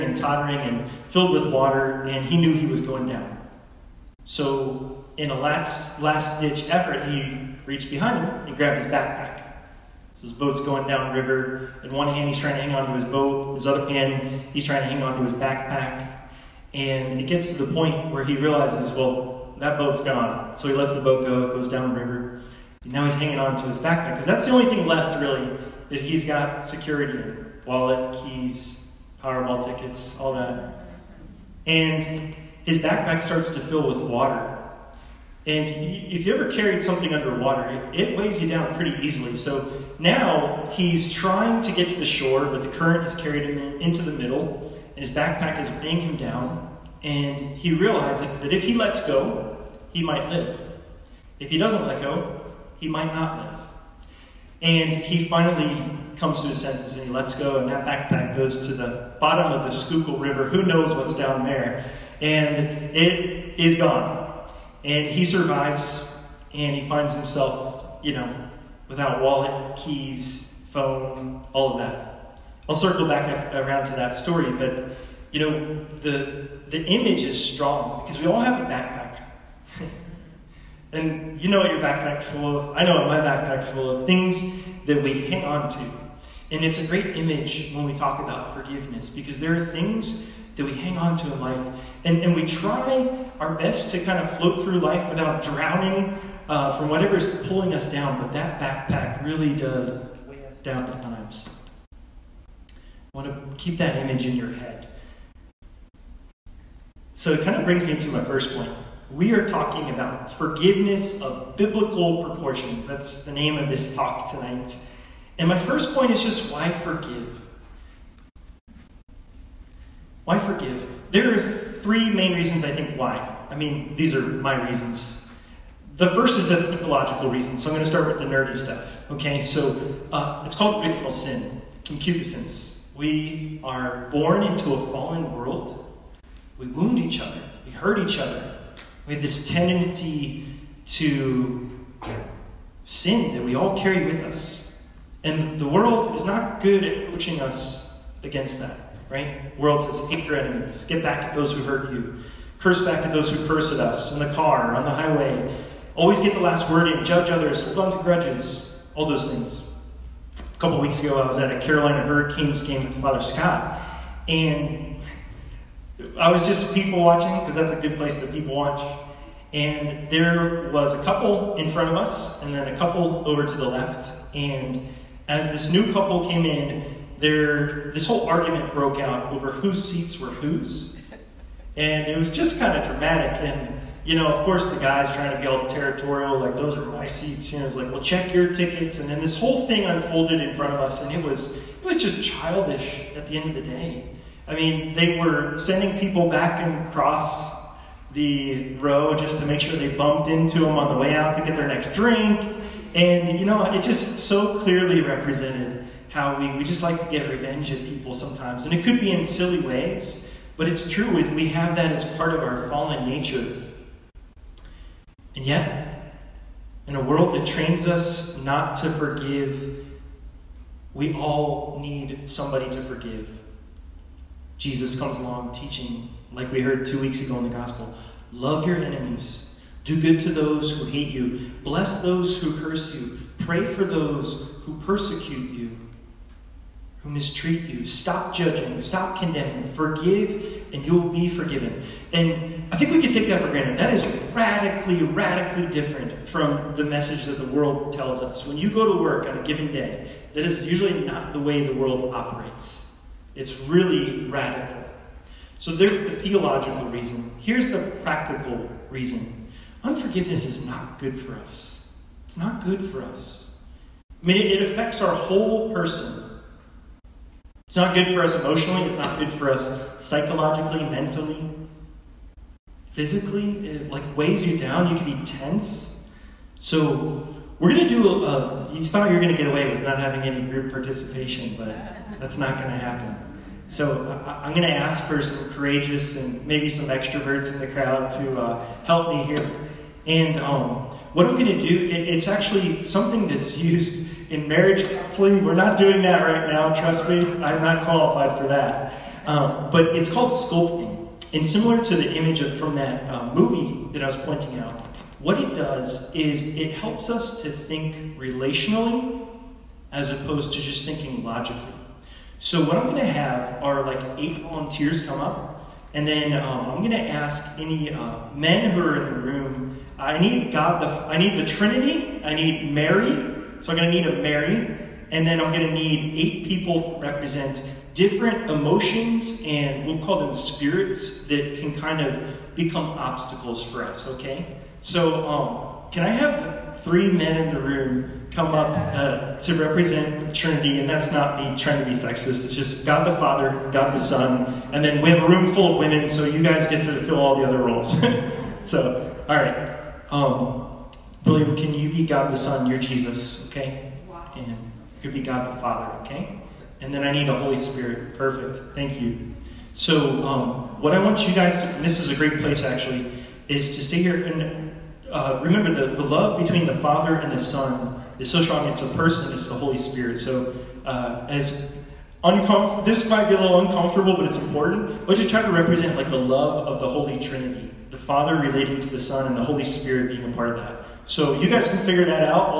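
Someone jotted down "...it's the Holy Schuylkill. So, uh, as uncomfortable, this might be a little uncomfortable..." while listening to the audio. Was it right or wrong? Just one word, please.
wrong.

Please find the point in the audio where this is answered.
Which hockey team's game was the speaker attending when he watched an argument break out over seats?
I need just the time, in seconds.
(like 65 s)
161 s.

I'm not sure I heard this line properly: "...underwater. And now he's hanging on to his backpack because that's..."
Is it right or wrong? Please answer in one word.
wrong.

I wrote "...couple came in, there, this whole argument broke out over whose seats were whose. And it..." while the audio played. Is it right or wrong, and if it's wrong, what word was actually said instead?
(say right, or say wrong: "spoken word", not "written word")
right.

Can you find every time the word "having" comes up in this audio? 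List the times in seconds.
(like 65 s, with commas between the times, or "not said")
279 s.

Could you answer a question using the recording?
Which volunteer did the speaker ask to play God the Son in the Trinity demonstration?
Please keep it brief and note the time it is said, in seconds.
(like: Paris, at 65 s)
William, at 351 s.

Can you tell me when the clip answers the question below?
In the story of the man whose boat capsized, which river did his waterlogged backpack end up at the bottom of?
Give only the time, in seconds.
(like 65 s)
59 s.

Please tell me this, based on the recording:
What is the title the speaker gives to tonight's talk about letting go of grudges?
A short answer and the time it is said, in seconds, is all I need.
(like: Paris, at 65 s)
Forgiveness of biblical proportions, at 110 s.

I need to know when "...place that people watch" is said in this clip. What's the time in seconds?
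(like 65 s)
167 s.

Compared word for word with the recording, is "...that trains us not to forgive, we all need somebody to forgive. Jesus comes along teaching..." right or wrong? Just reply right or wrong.
right.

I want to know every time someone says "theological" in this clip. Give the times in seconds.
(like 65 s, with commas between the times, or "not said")
126 s, 256 s.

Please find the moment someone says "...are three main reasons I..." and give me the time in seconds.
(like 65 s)
121 s.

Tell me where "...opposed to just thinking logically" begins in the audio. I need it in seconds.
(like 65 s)
310 s.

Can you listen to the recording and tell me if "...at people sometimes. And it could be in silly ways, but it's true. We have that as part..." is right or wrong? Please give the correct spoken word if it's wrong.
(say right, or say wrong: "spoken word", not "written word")
right.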